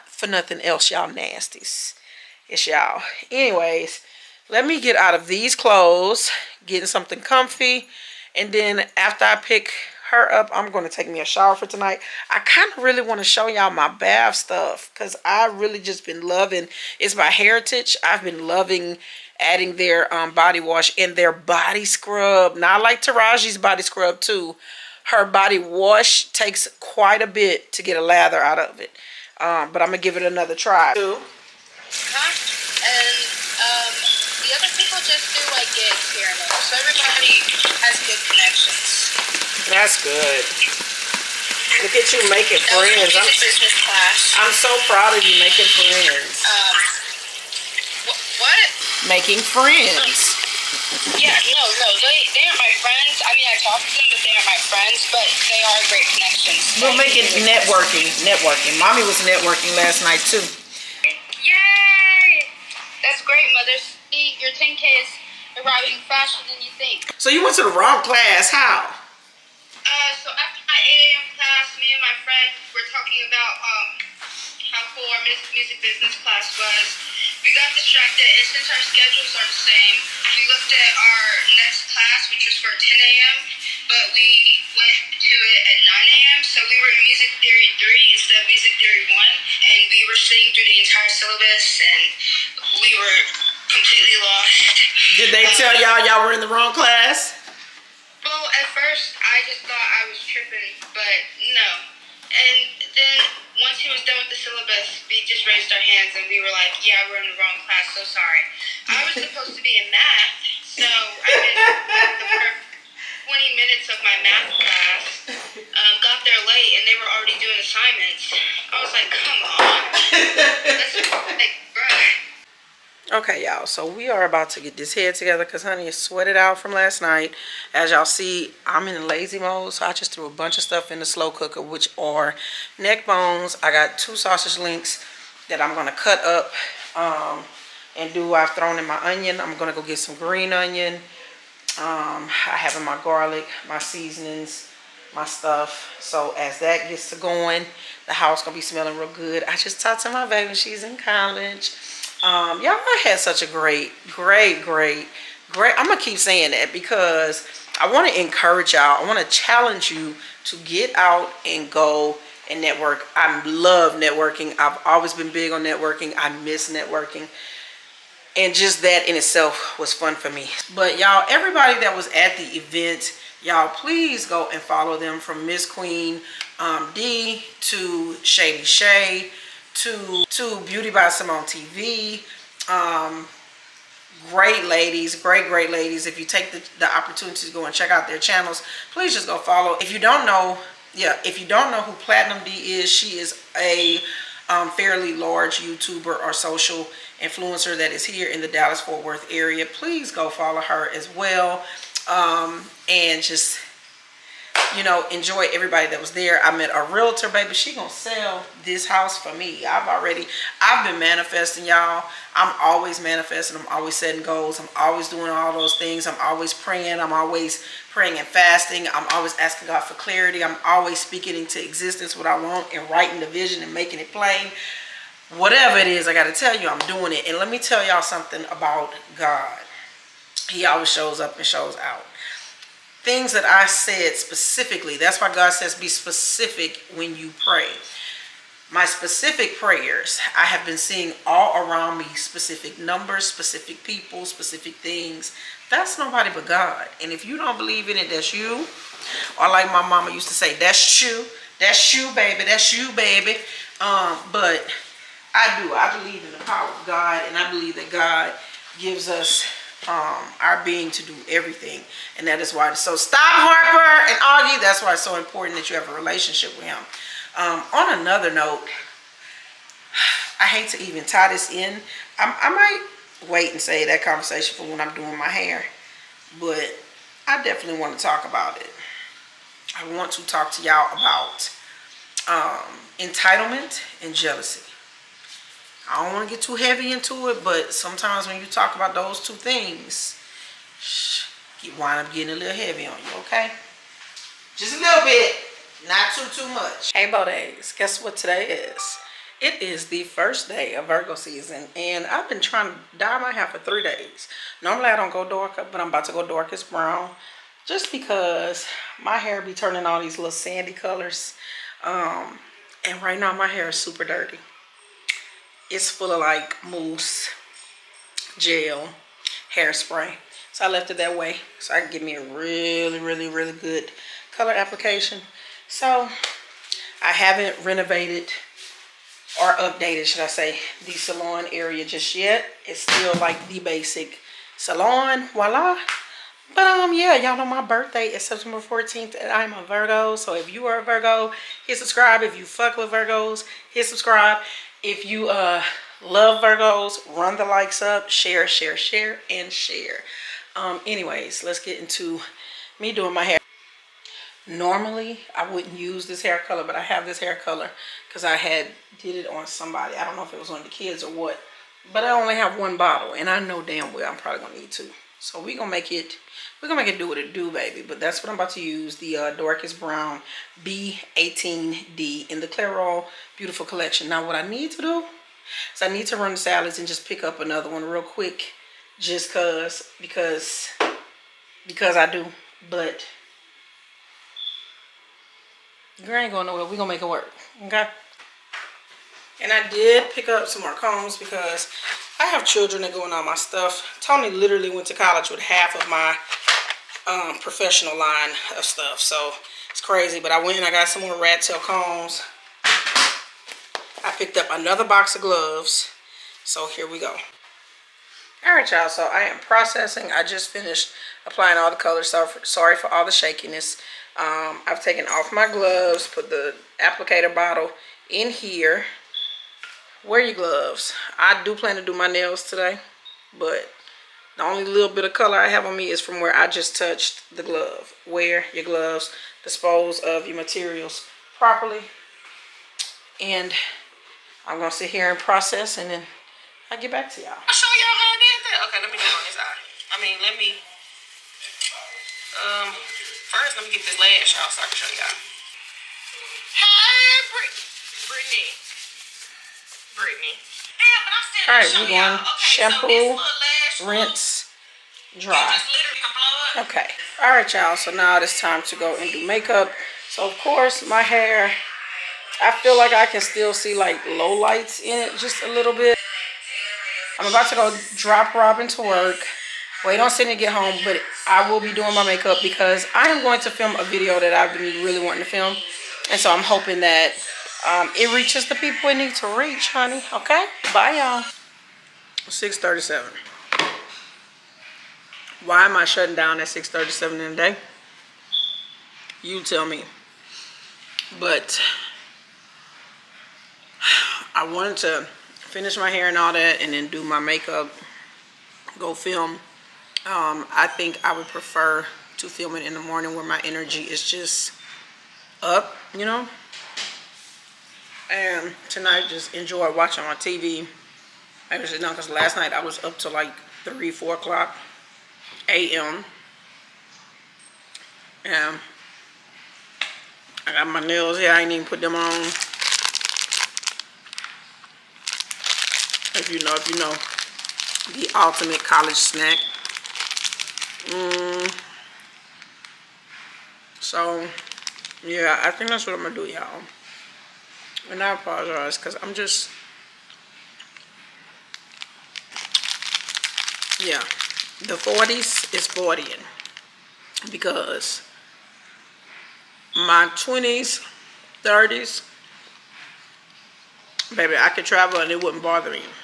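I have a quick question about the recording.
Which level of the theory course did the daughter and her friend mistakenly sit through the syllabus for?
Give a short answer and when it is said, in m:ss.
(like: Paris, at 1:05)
Music Theory 3, at 1:27.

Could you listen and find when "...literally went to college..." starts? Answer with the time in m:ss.
6:34.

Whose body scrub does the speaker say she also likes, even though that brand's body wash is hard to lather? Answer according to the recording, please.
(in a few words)
Taraji.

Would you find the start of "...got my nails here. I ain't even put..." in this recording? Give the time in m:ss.
8:40.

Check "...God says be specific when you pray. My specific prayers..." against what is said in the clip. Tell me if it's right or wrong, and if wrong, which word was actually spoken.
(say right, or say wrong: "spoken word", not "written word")
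right.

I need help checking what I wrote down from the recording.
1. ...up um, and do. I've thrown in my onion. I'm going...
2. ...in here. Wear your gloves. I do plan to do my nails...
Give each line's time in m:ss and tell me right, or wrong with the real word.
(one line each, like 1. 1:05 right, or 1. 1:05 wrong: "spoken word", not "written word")
1. 2:16 right
2. 6:58 right.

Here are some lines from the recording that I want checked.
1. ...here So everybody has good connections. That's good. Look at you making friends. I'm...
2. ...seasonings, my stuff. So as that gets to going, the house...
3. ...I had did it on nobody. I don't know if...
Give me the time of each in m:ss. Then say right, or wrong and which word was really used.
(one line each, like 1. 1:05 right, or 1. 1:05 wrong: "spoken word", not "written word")
1. 0:36 right
2. 2:23 right
3. 5:58 wrong: "somebody", not "nobody".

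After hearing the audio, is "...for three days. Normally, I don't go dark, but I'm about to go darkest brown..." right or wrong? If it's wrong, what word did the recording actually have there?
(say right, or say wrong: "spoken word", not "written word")
right.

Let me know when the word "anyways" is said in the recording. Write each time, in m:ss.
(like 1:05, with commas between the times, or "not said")
0:03, 5:50.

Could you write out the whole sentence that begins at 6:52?
So sorry for all the shakiness.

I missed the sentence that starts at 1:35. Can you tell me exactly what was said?
Did they tell y'all y'all were in the wrong class?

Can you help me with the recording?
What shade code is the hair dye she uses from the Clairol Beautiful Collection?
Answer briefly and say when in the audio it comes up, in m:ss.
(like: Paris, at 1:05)
Brown B18D, at 6:09.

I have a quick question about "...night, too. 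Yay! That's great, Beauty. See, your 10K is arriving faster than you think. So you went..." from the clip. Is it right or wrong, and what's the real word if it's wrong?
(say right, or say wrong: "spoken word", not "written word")
wrong: "Mother", not "Beauty".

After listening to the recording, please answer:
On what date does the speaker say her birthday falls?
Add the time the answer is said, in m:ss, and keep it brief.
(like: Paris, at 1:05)
September 14th, at 5:38.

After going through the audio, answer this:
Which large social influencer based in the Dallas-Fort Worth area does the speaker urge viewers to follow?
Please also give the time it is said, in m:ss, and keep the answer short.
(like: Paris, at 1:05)
Platinum D, at 3:11.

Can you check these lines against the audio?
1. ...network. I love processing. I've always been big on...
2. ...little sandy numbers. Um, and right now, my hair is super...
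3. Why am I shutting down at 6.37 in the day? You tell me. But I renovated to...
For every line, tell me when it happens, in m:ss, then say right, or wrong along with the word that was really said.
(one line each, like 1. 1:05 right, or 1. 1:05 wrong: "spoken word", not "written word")
1. 2:42 wrong: "networking", not "processing"
2. 5:10 wrong: "colors", not "numbers"
3. 8:05 wrong: "wanted", not "renovated".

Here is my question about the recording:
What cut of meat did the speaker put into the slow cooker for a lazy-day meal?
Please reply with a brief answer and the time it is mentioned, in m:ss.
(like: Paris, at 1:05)
Neck bones, at 2:12.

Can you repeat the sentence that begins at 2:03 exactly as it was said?
Okay, y'all, so we are about to get this head together because honey is sweated out from last night.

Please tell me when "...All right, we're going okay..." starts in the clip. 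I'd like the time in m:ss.
7:31.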